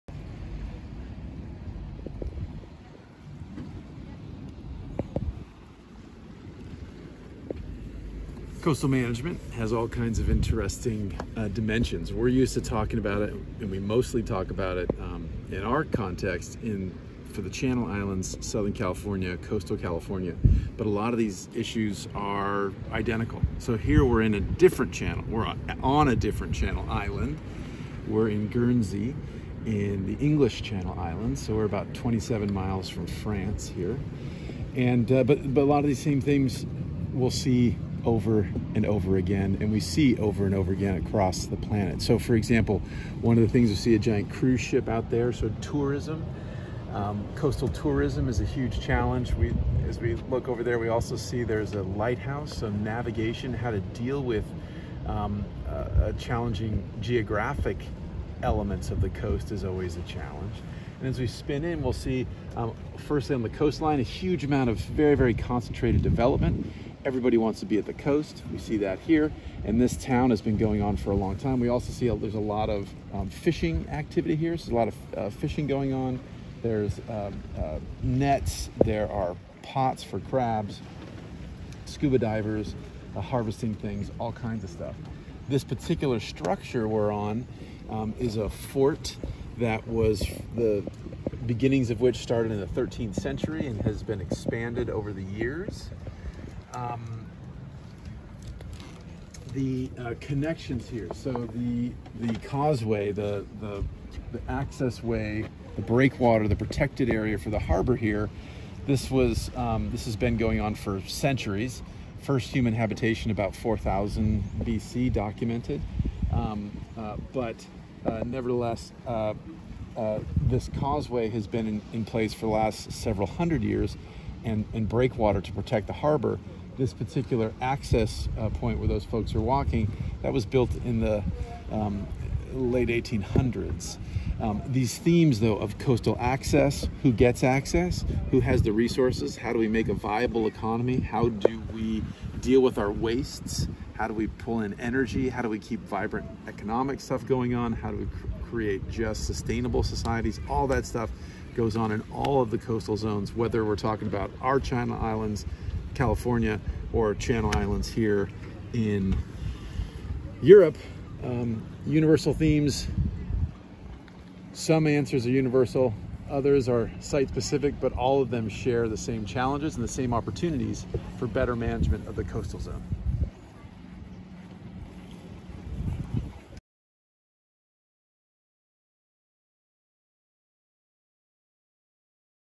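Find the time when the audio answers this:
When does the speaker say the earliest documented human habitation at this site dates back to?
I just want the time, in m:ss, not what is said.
1:53.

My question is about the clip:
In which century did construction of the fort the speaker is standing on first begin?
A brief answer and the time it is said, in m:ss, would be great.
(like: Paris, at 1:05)
13th century, at 1:32.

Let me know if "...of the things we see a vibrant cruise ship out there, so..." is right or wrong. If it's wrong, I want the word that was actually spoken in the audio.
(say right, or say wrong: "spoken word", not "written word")
wrong: "giant", not "vibrant".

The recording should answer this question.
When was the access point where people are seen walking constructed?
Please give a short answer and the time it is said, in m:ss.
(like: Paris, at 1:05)
Late 1800s, at 2:12.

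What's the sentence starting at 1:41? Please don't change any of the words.
So the the causeway, the, the the access way, the breakwater, the protected area for the harbor here.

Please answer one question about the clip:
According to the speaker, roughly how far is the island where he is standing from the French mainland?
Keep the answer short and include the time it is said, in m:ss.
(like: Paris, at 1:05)
27 miles, at 0:31.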